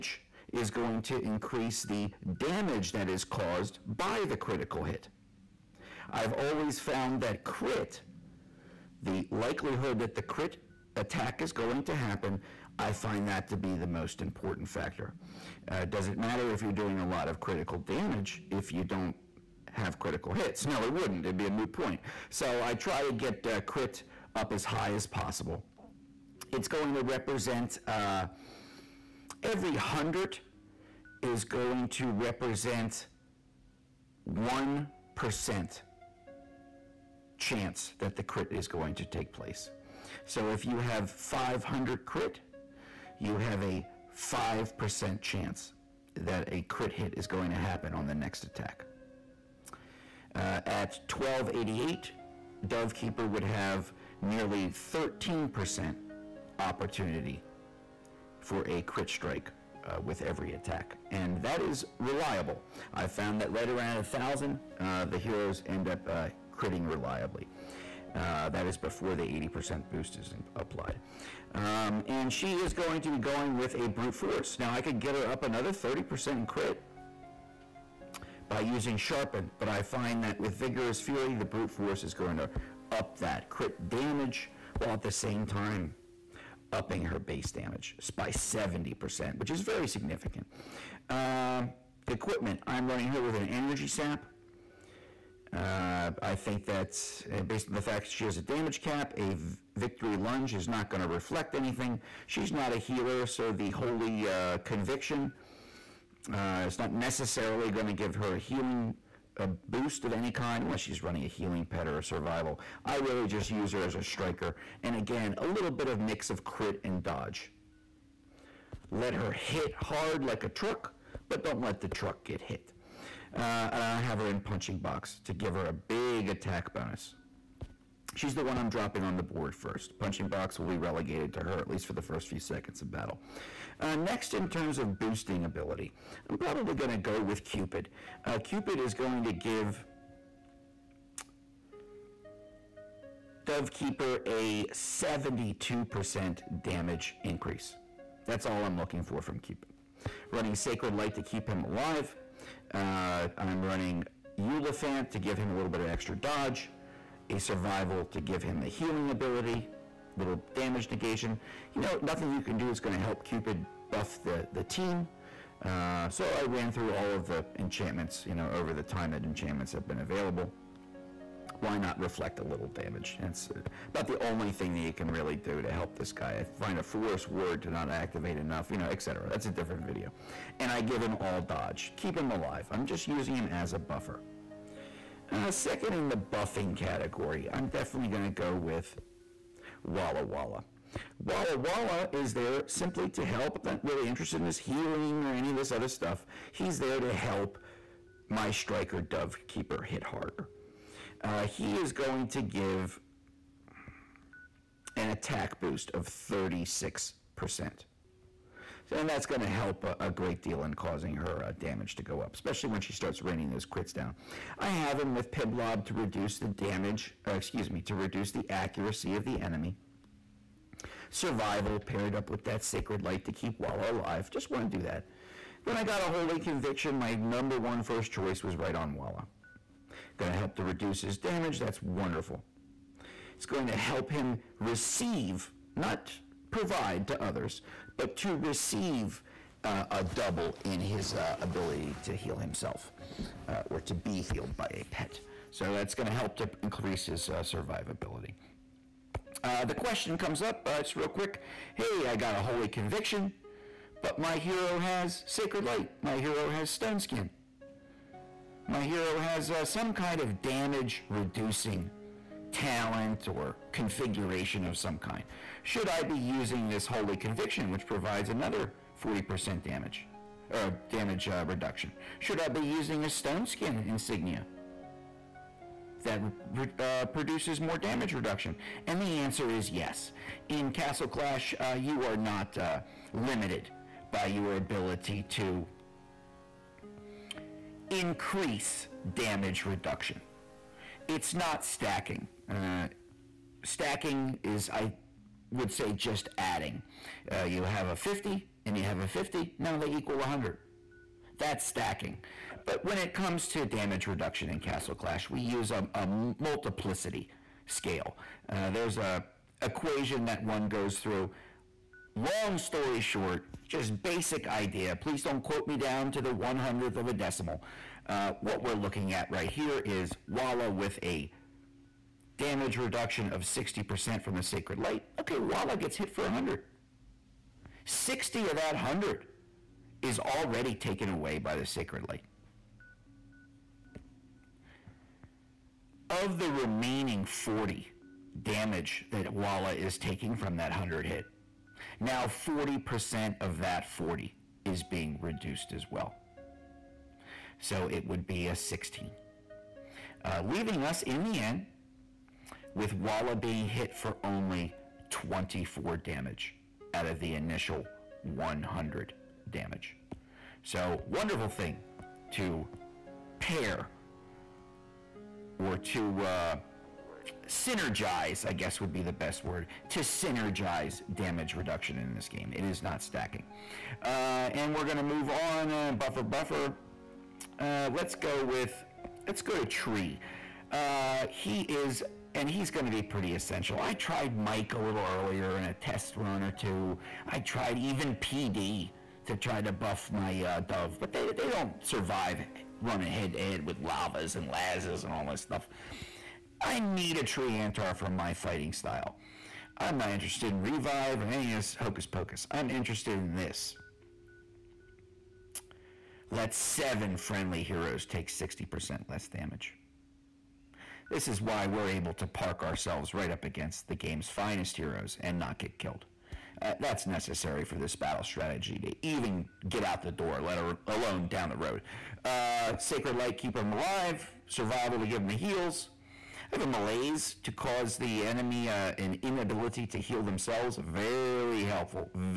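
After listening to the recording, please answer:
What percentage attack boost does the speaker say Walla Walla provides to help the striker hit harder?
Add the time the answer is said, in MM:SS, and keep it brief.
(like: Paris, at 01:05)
36%, at 03:26.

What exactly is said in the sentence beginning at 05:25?
Okay, Walla gets hit for 100.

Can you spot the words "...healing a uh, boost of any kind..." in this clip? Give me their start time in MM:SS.
01:48.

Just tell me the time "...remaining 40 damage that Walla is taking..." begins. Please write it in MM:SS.
05:36.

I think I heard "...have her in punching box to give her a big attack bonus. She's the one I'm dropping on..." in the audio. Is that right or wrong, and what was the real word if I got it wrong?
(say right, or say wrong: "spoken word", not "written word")
right.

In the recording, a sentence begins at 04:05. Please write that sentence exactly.
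So that's going to help to increase his uh, survivability.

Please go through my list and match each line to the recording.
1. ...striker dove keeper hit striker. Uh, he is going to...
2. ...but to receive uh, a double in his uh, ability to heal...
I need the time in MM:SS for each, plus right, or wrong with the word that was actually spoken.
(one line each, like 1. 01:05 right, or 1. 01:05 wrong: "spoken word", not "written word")
1. 03:18 wrong: "harder", not "striker"
2. 03:57 right.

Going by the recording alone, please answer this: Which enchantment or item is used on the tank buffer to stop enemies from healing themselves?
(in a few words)
malaise.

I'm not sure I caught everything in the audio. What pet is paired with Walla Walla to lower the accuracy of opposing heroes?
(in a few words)
Piblob.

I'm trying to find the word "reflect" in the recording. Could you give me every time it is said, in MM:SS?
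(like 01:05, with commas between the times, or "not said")
01:41, 02:51.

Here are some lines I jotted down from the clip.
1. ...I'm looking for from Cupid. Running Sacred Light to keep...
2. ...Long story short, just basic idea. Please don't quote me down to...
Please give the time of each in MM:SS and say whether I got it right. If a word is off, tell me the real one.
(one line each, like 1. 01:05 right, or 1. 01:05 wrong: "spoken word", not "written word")
1. 02:28 right
2. 05:12 right.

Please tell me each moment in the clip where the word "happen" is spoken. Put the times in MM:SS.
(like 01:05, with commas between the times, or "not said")
00:11, 00:47.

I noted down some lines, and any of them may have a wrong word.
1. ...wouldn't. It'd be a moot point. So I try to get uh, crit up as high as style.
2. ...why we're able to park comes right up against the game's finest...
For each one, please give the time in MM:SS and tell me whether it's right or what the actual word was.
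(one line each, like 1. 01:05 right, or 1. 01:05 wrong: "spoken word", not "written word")
1. 00:20 wrong: "possible", not "style"
2. 06:51 wrong: "ourselves", not "comes".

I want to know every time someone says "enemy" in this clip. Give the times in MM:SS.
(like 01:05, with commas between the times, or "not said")
03:39, 07:08.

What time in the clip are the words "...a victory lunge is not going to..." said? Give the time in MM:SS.
01:39.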